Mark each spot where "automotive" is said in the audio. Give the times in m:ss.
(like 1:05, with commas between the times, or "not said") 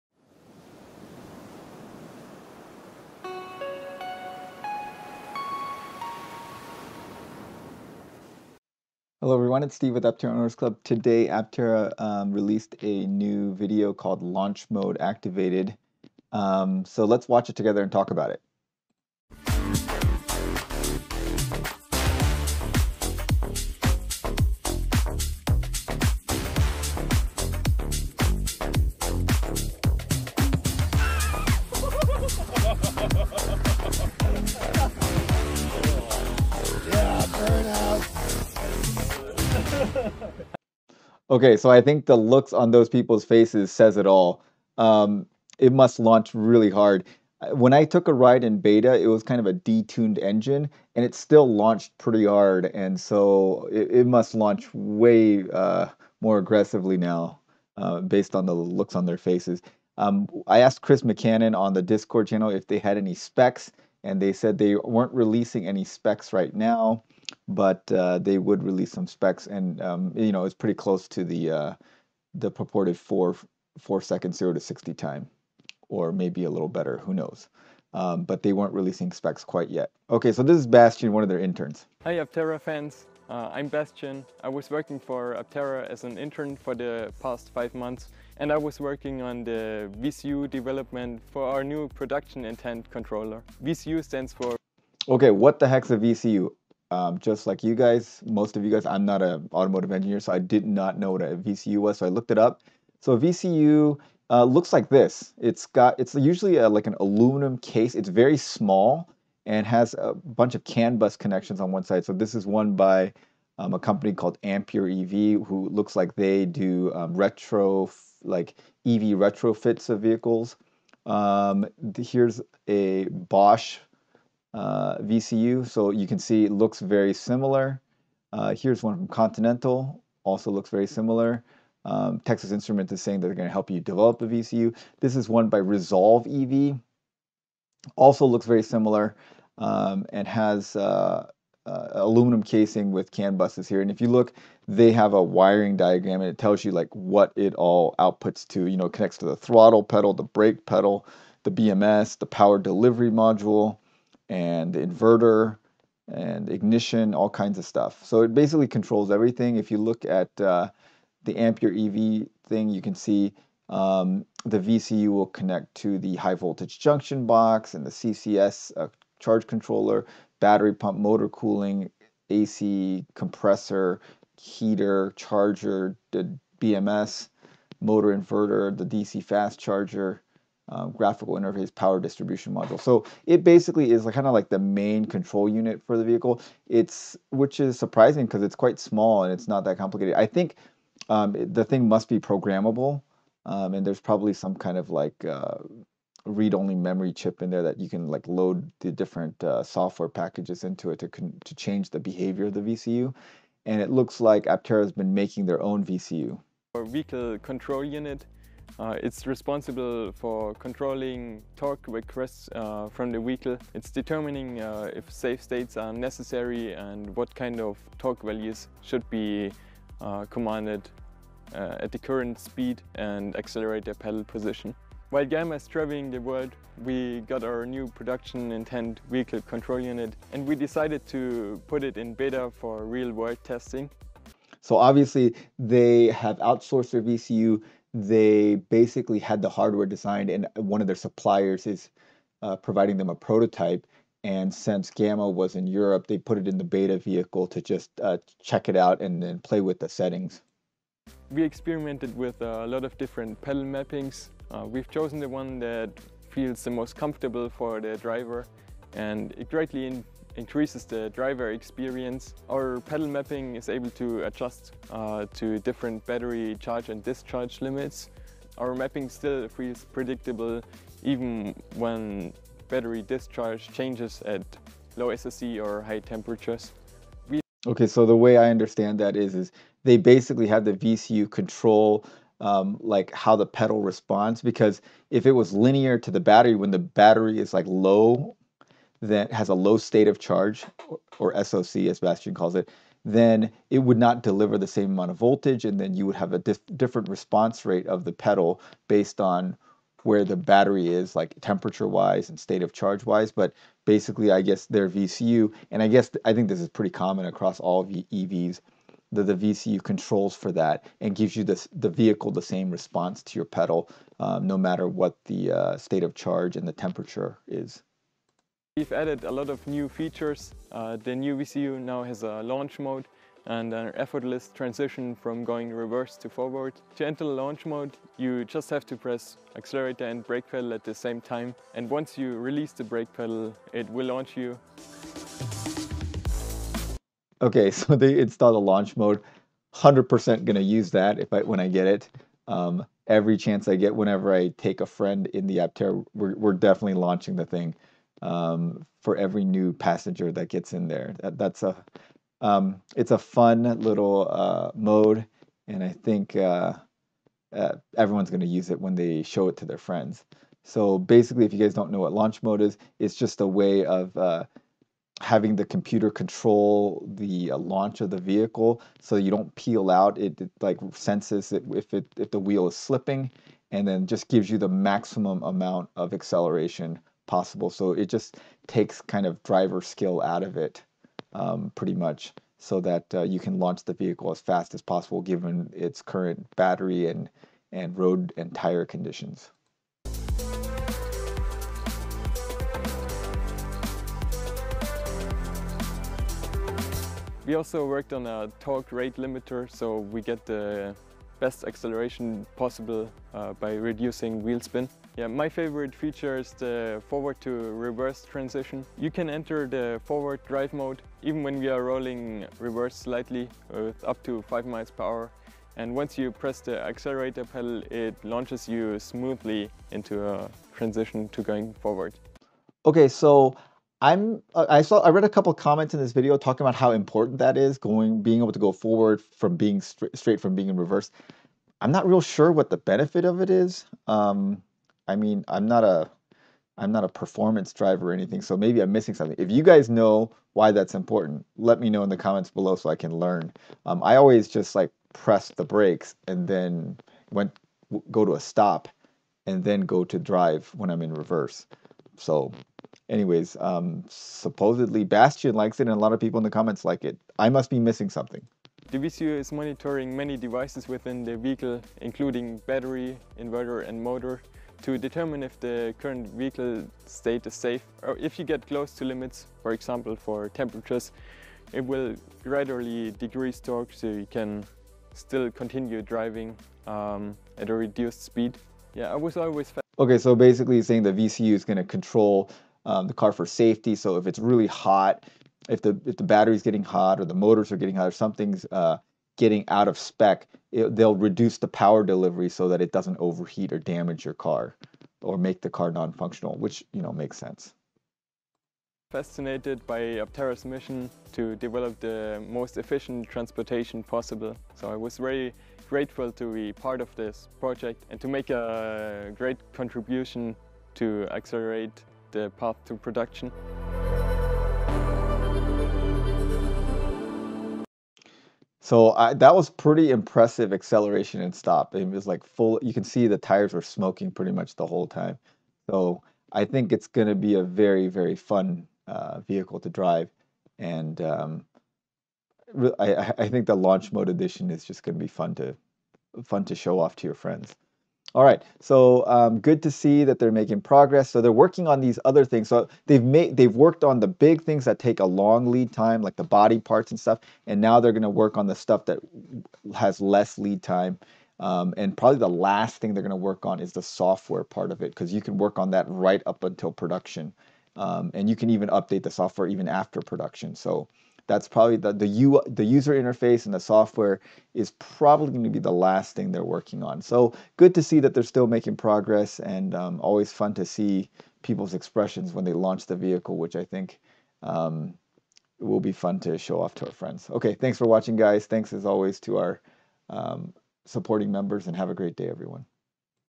1:39.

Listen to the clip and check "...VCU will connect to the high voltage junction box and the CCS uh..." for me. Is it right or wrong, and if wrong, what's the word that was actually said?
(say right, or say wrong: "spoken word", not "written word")
right.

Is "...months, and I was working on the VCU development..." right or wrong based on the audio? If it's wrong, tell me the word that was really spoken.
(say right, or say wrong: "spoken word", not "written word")
right.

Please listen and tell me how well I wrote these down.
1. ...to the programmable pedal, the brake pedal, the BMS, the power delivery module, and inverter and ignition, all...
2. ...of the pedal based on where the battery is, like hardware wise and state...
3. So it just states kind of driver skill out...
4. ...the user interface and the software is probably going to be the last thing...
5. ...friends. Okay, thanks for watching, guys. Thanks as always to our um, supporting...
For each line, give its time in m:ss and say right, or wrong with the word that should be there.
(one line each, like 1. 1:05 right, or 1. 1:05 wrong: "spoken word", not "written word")
1. 2:29 wrong: "throttle", not "programmable"
2. 4:57 wrong: "temperature", not "hardware"
3. 6:17 wrong: "takes", not "states"
4. 9:22 right
5. 9:37 right.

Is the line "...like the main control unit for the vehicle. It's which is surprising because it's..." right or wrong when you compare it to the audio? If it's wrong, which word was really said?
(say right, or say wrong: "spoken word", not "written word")
right.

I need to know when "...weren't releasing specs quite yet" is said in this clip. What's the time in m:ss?
1:18.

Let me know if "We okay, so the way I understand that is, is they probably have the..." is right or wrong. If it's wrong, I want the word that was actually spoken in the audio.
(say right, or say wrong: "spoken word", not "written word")
wrong: "basically", not "probably".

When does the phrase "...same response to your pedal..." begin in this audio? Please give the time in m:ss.
5:12.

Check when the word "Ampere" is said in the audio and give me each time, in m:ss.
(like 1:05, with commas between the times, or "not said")
1:54, 2:41.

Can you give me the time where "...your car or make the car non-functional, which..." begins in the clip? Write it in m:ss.
8:14.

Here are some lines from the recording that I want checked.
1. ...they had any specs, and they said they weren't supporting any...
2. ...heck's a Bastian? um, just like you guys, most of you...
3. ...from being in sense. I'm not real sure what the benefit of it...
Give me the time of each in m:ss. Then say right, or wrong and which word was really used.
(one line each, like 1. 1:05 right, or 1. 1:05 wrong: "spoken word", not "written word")
1. 1:02 wrong: "releasing", not "supporting"
2. 1:35 wrong: "VCU", not "Bastian"
3. 7:10 wrong: "reverse", not "sense".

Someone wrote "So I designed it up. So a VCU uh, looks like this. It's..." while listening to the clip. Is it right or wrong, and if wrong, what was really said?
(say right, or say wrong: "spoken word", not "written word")
wrong: "looked", not "designed".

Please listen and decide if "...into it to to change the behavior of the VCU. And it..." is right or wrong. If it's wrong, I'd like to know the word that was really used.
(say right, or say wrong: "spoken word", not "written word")
right.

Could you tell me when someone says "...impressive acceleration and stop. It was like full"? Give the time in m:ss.
8:40.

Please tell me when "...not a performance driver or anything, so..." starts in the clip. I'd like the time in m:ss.
7:16.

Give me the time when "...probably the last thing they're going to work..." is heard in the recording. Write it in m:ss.
9:12.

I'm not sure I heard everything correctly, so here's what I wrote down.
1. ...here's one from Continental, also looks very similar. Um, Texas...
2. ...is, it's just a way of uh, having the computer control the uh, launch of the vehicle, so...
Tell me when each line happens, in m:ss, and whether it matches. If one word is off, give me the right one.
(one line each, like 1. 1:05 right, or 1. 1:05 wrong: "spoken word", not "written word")
1. 2:08 right
2. 6:02 right.